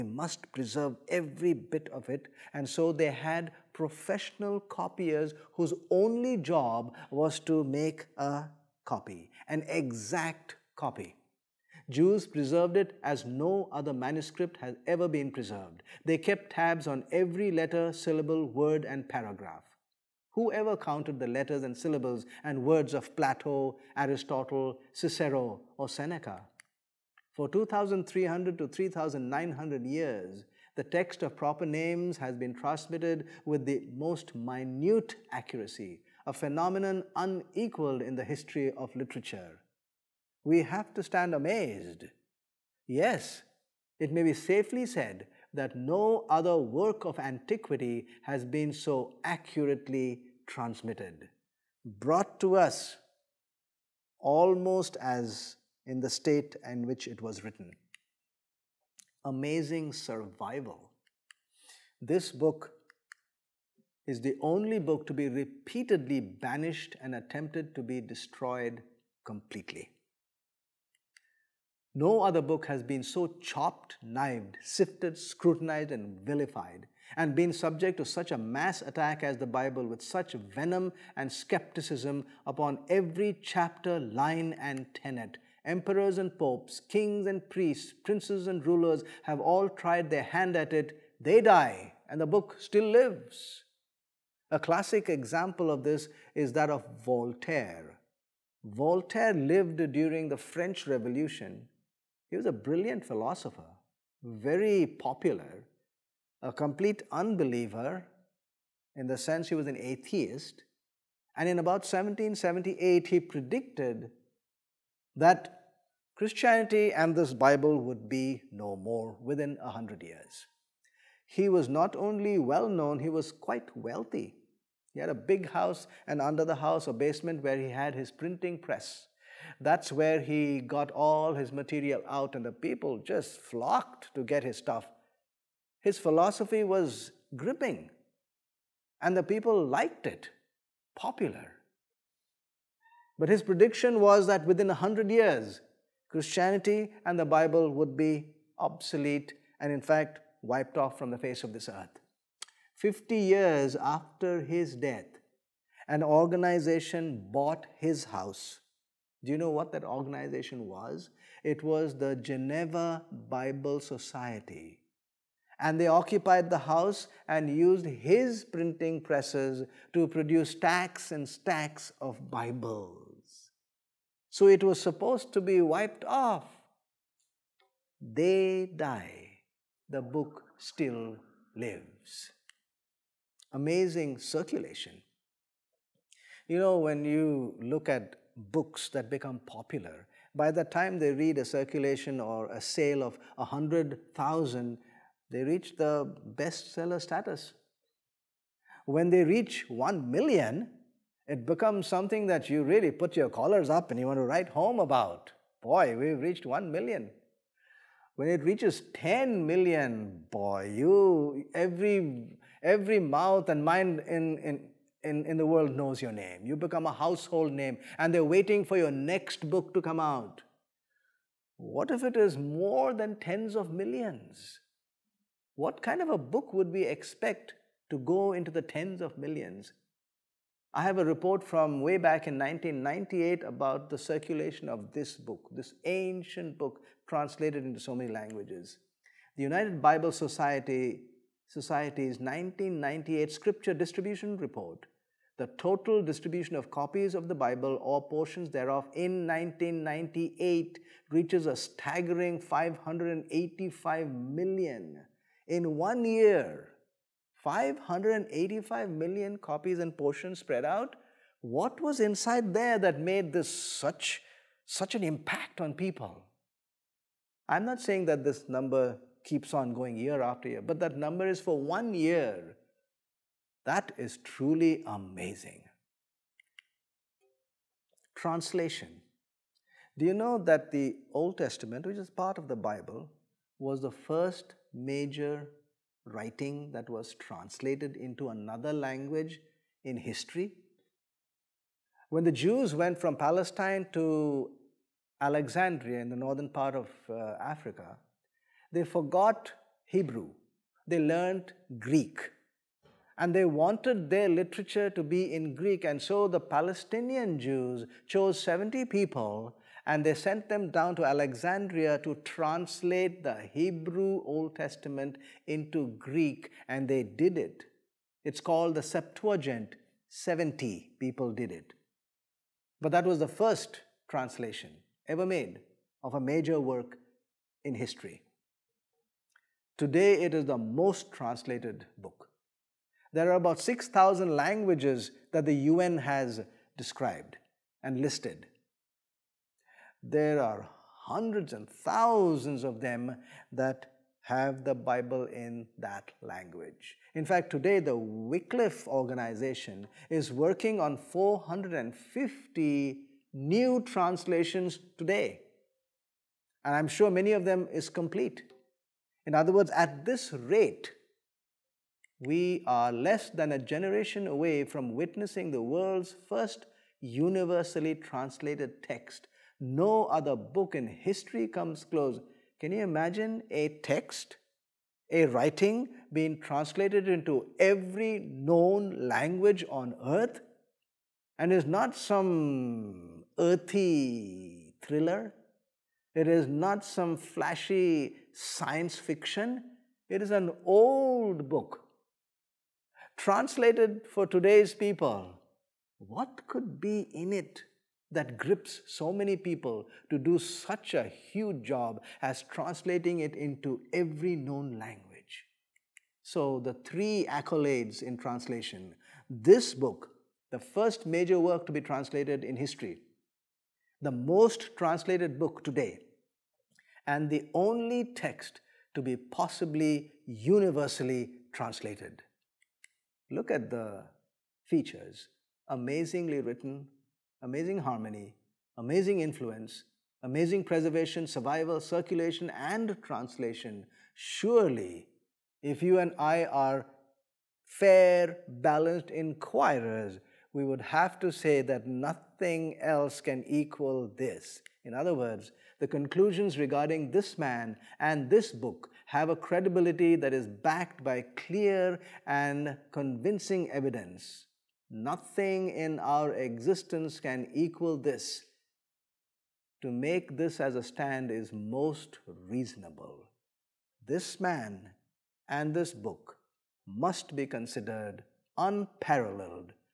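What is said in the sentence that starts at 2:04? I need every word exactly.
He had a big house and under the house a basement where he had his printing press.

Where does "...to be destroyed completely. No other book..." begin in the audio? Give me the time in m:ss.
1:07.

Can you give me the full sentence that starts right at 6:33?
Translated for today's people, what could be in it?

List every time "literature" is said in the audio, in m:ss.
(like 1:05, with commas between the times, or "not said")
0:38, 5:04.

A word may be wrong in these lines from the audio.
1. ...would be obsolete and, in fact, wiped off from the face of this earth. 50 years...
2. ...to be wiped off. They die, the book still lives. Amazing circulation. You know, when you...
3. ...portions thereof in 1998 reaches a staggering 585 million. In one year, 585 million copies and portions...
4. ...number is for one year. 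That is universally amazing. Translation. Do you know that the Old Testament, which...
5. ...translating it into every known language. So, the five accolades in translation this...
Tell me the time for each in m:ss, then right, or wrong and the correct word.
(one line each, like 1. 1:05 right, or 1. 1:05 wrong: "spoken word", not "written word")
1. 2:27 right
2. 2:55 right
3. 4:08 right
4. 4:30 wrong: "truly", not "universally"
5. 6:42 wrong: "three", not "five".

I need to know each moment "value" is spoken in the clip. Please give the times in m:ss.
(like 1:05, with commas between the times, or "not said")
not said.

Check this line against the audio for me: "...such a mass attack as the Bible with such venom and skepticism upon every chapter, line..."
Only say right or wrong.
right.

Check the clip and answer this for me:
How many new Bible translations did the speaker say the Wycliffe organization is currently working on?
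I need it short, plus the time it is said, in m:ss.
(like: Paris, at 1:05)
450, at 5:50.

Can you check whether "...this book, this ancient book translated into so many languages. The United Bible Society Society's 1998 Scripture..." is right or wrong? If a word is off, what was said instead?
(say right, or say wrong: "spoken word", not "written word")
right.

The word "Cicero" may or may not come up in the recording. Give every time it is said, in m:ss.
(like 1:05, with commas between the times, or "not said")
0:24.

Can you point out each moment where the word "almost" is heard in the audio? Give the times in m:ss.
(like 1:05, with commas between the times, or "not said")
0:54.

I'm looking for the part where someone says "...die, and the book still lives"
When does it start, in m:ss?
1:31.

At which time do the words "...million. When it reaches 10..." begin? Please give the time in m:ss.
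3:26.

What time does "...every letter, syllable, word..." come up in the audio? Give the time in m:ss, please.
0:17.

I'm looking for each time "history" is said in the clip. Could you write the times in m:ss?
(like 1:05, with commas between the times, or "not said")
0:38, 4:49, 5:27, 6:10, 6:52.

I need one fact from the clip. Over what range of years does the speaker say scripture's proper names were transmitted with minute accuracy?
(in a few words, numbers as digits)
2,300 to 3,900 years.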